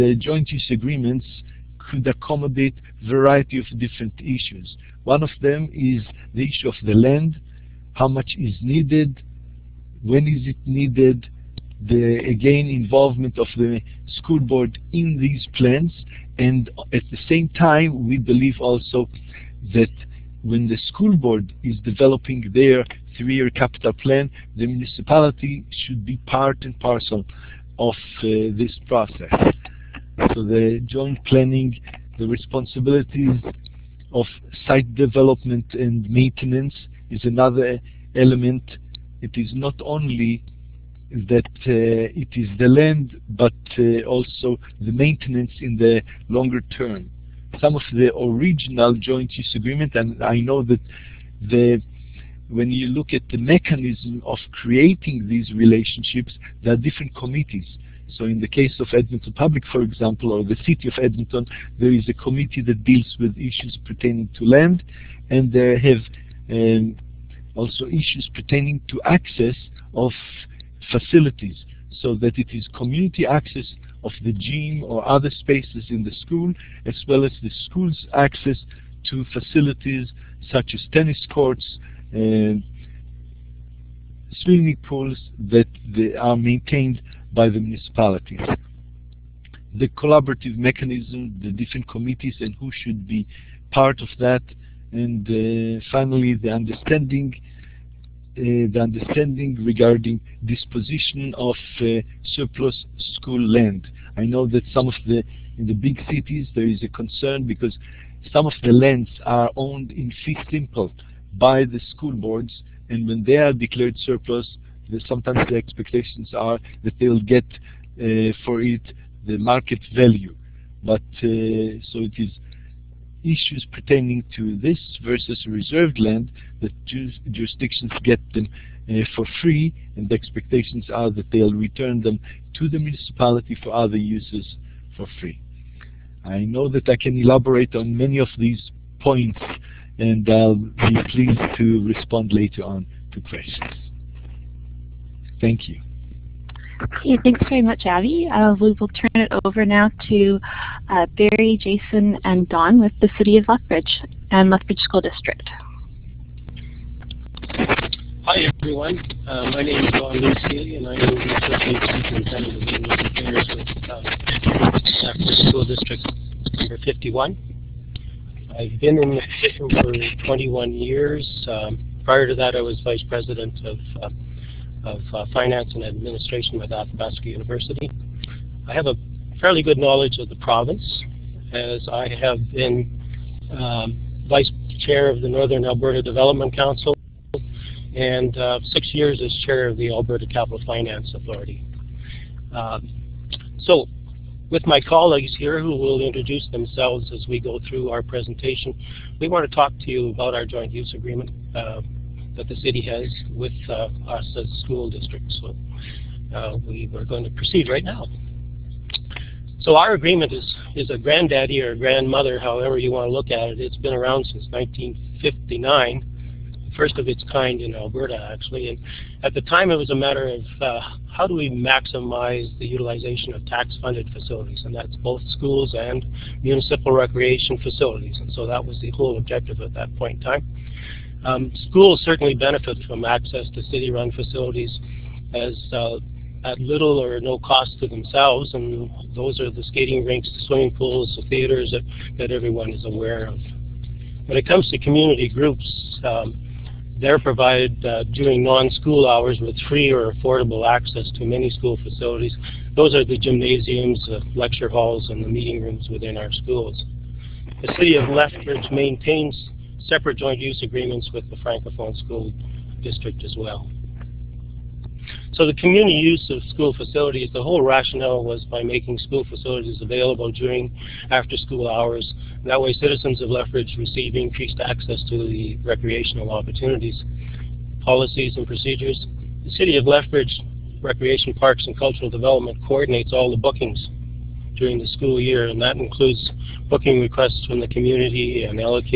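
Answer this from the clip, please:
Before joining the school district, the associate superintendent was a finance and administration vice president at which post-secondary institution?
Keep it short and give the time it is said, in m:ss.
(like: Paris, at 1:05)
Athabasca University, at 2:56.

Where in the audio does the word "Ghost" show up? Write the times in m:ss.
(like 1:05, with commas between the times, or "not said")
not said.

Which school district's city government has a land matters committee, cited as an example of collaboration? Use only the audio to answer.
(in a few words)
Edmonton Public.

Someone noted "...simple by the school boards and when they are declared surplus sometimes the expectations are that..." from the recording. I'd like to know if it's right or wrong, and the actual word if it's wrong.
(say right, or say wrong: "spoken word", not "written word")
right.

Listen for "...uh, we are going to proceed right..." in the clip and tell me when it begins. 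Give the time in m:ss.
3:26.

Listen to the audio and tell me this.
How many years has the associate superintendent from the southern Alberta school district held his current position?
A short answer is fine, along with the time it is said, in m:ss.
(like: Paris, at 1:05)
21, at 2:50.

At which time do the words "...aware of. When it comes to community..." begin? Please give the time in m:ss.
4:02.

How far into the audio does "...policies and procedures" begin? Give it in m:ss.
4:37.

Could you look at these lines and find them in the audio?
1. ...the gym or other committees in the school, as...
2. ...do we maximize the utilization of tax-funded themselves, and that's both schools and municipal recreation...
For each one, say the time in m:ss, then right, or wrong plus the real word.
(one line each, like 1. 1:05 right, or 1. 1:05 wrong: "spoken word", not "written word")
1. 1:14 wrong: "spaces", not "committees"
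2. 3:41 wrong: "facilities", not "themselves".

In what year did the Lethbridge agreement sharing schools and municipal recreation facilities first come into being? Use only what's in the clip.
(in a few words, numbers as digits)
1959.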